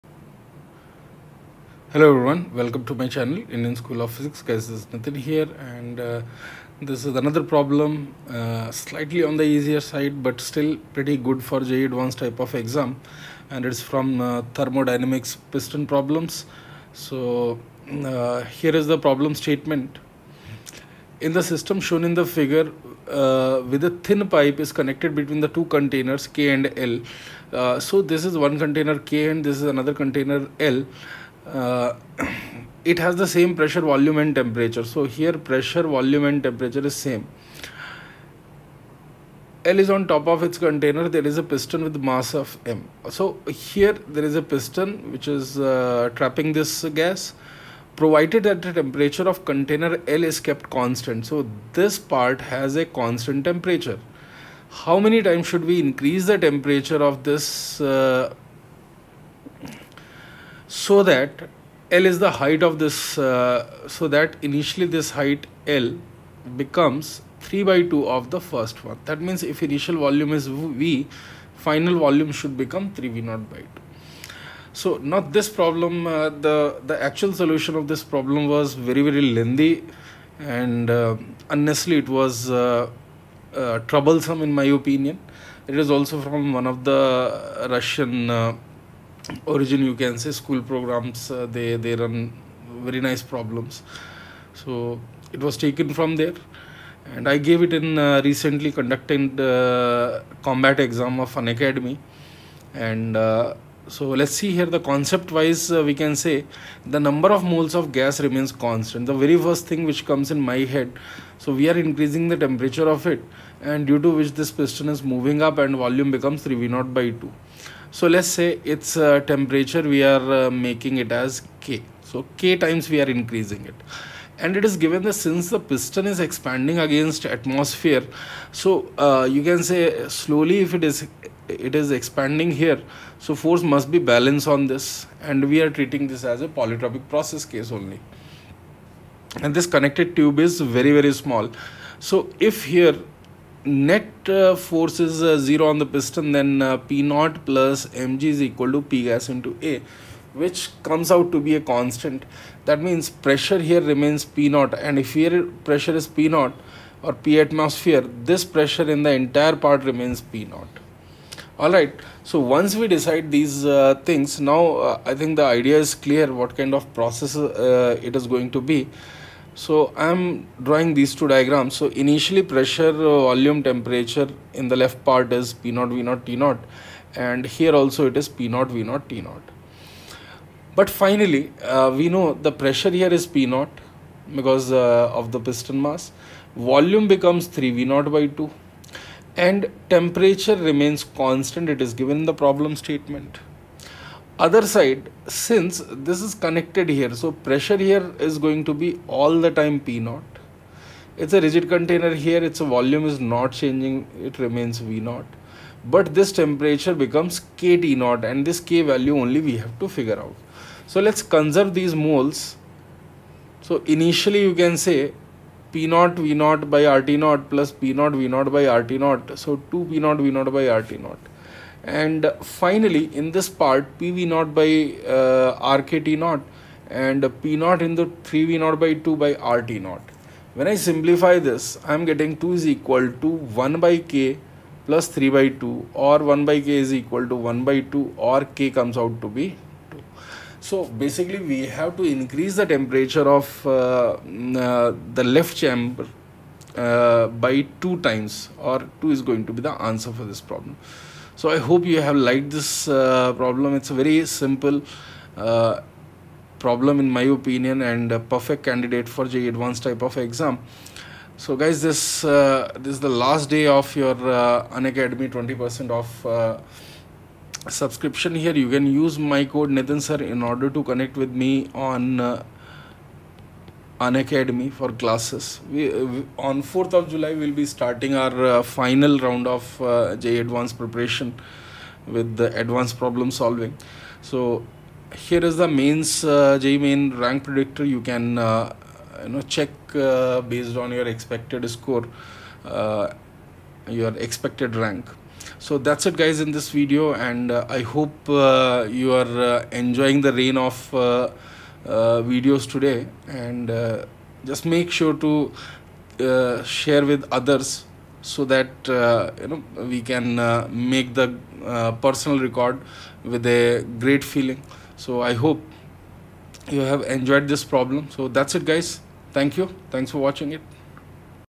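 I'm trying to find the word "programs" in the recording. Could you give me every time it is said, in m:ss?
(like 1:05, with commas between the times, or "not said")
1:30.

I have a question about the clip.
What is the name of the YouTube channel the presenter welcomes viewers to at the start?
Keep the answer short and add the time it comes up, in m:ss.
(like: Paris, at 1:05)
Indian School of Physics, at 0:03.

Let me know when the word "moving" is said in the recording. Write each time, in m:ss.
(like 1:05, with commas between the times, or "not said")
1:55.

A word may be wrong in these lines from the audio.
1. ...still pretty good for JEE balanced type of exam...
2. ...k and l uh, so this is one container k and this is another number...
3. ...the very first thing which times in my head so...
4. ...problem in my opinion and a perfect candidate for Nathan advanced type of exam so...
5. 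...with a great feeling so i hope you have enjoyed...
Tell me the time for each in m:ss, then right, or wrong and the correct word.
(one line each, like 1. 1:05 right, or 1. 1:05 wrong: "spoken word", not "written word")
1. 0:10 wrong: "advanced", not "balanced"
2. 0:26 wrong: "container", not "number"
3. 1:49 wrong: "comes", not "times"
4. 4:16 wrong: "JEE", not "Nathan"
5. 5:13 right.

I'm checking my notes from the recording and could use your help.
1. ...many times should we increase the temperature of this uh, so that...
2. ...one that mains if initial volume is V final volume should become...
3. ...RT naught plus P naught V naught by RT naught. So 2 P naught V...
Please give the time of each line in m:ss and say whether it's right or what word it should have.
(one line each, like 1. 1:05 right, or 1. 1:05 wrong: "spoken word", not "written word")
1. 0:54 right
2. 1:08 wrong: "means", not "mains"
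3. 3:36 right.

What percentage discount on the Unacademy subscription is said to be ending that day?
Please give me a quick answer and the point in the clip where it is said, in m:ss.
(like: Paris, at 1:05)
20%, at 4:25.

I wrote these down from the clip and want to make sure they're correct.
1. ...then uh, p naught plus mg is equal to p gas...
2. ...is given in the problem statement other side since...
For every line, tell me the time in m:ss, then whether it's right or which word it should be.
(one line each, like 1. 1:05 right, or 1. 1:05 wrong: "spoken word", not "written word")
1. 2:26 right
2. 3:11 right.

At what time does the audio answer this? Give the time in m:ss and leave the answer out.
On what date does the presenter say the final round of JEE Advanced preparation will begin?
4:36.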